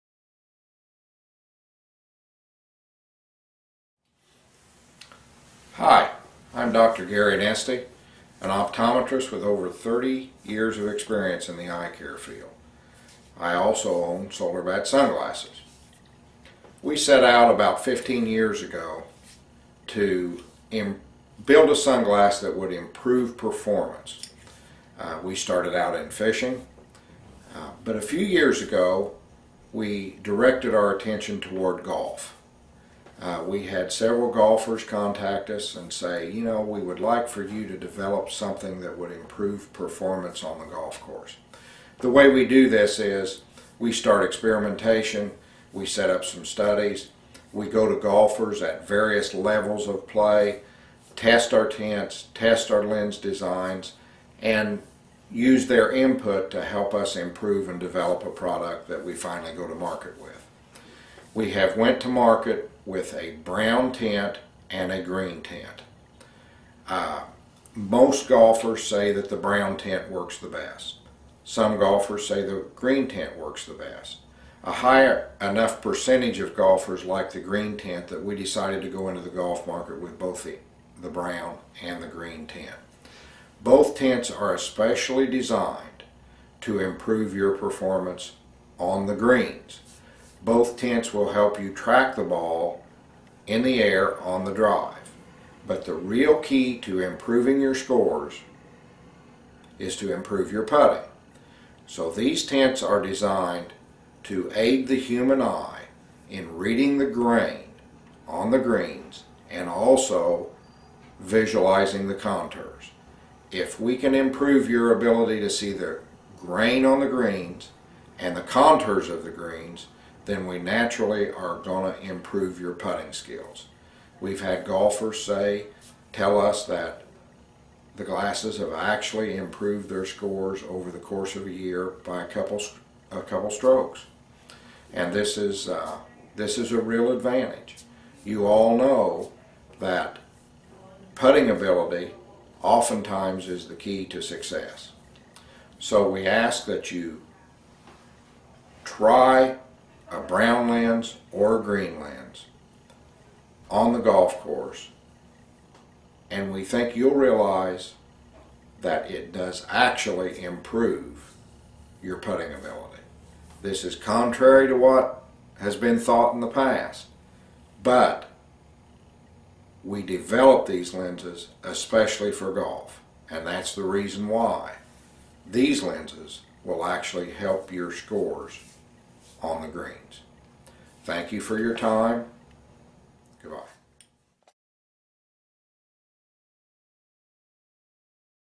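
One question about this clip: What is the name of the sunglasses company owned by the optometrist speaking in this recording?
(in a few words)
SolarBat.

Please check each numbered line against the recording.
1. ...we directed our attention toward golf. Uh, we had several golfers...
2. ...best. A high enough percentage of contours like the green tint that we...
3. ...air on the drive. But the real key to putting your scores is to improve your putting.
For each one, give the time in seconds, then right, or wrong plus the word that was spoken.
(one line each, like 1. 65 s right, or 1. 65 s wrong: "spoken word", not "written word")
1. 29 s right
2. 73 s wrong: "golfers", not "contours"
3. 93 s wrong: "improving", not "putting".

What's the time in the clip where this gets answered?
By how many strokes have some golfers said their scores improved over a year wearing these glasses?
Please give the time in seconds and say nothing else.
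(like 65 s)
133 s.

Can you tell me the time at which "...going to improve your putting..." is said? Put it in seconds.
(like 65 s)
121 s.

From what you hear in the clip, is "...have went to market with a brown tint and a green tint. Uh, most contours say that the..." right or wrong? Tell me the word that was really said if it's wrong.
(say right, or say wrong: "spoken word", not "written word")
wrong: "golfers", not "contours".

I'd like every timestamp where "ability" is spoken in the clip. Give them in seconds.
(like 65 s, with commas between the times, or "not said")
114 s, 141 s, 162 s.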